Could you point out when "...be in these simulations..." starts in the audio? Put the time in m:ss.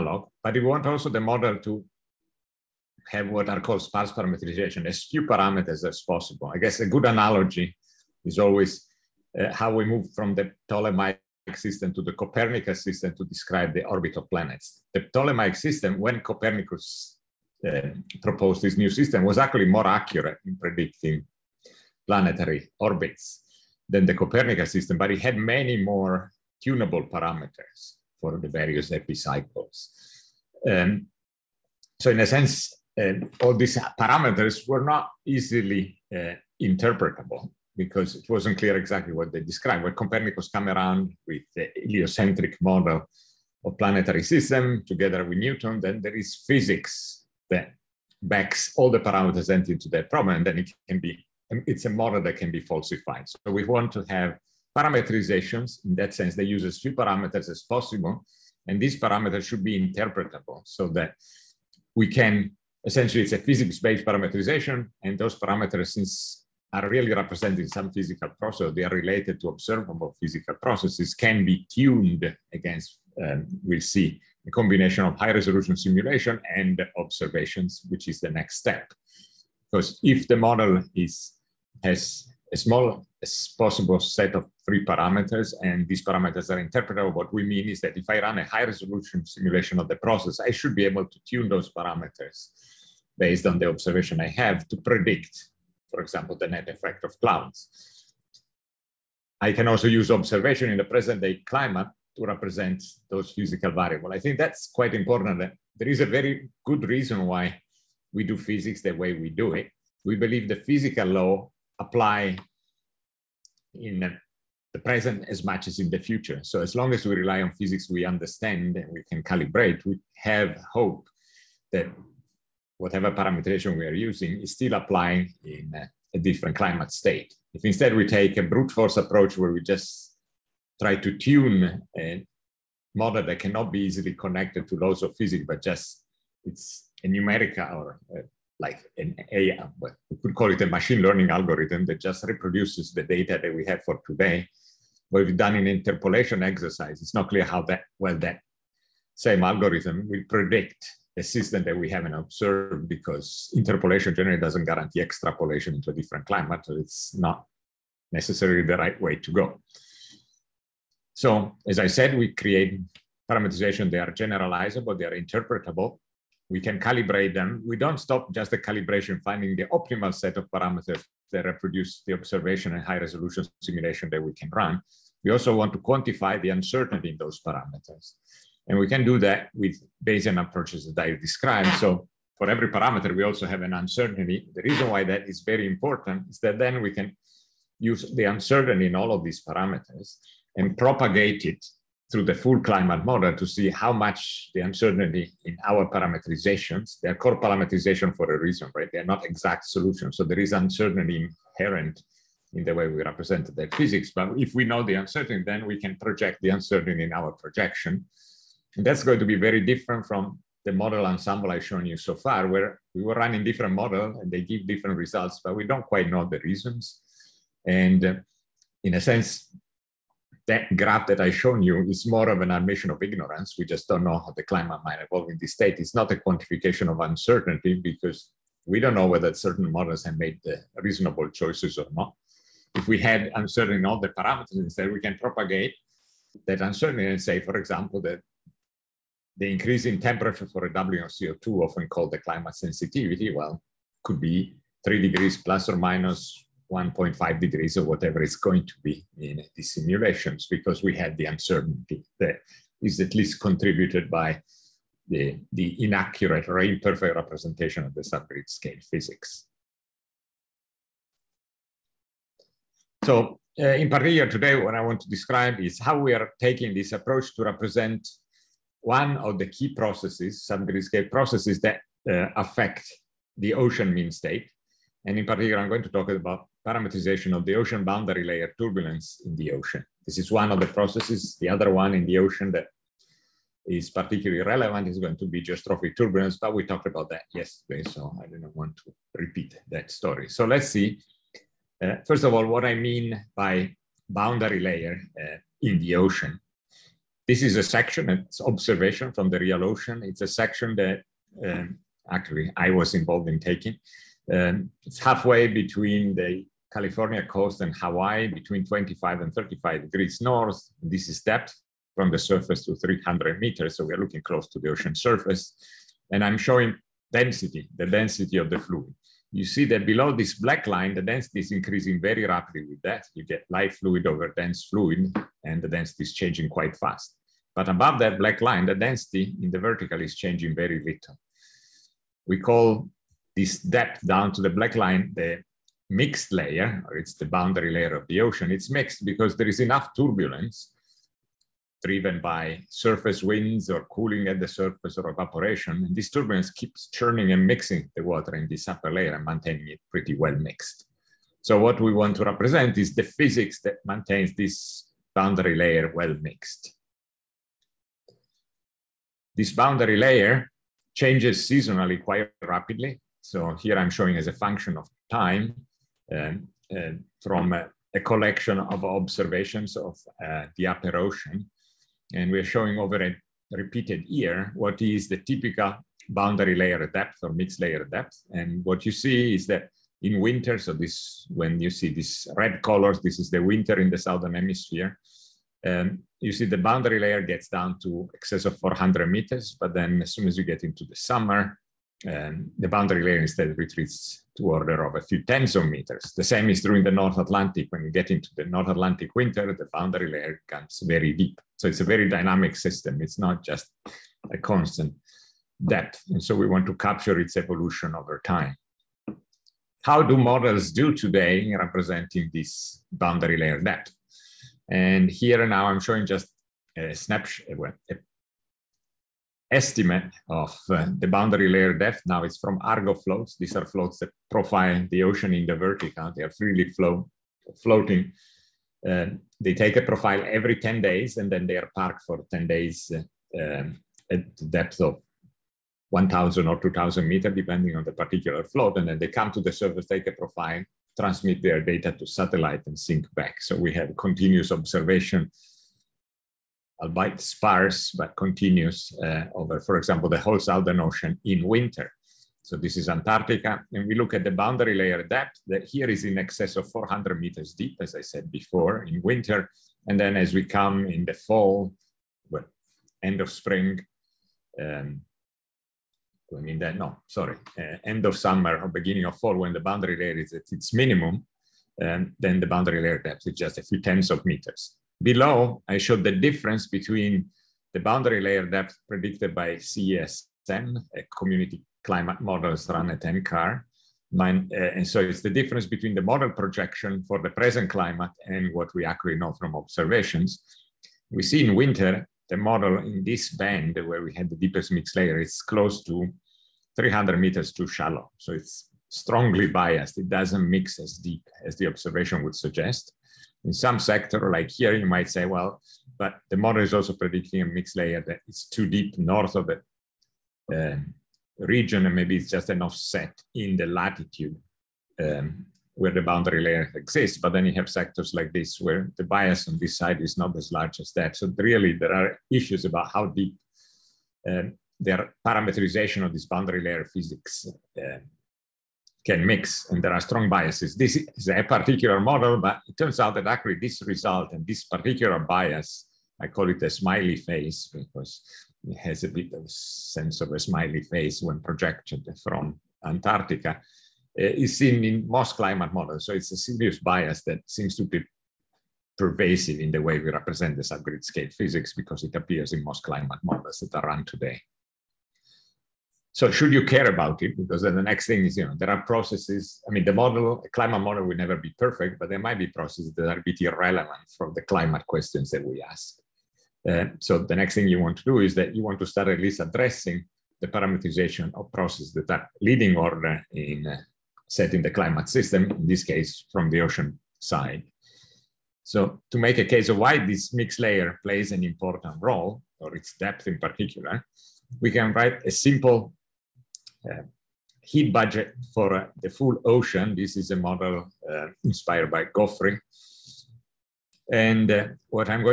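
4:08.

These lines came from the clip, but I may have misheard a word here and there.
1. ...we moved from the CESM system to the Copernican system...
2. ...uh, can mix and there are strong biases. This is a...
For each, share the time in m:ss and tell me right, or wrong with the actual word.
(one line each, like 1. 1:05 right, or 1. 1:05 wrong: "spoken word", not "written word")
1. 0:09 wrong: "Ptolemaic", not "CESM"
2. 8:47 right.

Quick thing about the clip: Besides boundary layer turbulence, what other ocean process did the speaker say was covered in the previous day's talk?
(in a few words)
geostrophic turbulence.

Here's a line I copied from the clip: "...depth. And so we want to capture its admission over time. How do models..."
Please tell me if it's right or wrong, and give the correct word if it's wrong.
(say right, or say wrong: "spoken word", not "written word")
wrong: "evolution", not "admission".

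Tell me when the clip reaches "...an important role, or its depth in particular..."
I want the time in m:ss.
9:41.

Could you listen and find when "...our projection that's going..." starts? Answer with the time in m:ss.
3:27.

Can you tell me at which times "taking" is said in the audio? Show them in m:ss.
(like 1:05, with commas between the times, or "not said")
4:26, 5:03.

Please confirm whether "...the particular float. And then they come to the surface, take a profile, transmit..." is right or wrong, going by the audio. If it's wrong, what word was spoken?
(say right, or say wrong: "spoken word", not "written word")
right.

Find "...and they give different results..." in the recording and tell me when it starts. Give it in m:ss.
3:34.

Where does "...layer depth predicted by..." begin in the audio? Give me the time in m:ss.
7:58.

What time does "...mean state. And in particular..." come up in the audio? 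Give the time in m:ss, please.
4:33.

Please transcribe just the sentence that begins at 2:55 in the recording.
We also want to quantify the uncertainty in those parameters.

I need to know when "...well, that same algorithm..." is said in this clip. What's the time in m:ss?
2:27.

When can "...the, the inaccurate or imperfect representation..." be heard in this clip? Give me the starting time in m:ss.
4:15.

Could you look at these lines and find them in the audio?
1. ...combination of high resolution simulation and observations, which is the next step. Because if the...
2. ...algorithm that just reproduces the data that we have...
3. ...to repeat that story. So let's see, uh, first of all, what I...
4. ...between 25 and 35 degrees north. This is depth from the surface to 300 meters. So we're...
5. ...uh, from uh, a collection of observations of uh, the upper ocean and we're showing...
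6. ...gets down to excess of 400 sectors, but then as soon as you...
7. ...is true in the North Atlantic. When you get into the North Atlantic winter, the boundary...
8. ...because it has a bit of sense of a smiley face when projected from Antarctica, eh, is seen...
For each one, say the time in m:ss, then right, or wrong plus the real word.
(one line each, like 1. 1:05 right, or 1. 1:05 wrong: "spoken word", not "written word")
1. 1:14 right
2. 2:21 right
3. 4:48 right
4. 5:08 right
5. 6:06 right
6. 6:27 wrong: "meters", not "sectors"
7. 6:36 right
8. 8:57 right.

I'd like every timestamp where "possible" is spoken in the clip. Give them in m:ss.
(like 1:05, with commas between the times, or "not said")
0:06, 0:57, 1:23.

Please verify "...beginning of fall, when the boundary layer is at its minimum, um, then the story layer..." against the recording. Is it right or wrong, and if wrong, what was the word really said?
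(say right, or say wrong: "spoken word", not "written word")
wrong: "boundary", not "story".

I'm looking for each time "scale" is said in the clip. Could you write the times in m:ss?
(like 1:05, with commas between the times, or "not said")
4:18, 9:11.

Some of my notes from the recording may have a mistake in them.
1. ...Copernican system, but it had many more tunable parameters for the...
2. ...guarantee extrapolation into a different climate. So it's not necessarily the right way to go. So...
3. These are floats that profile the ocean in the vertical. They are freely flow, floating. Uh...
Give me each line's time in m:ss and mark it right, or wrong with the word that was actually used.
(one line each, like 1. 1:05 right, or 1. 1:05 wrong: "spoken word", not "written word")
1. 0:24 right
2. 2:34 right
3. 7:03 right.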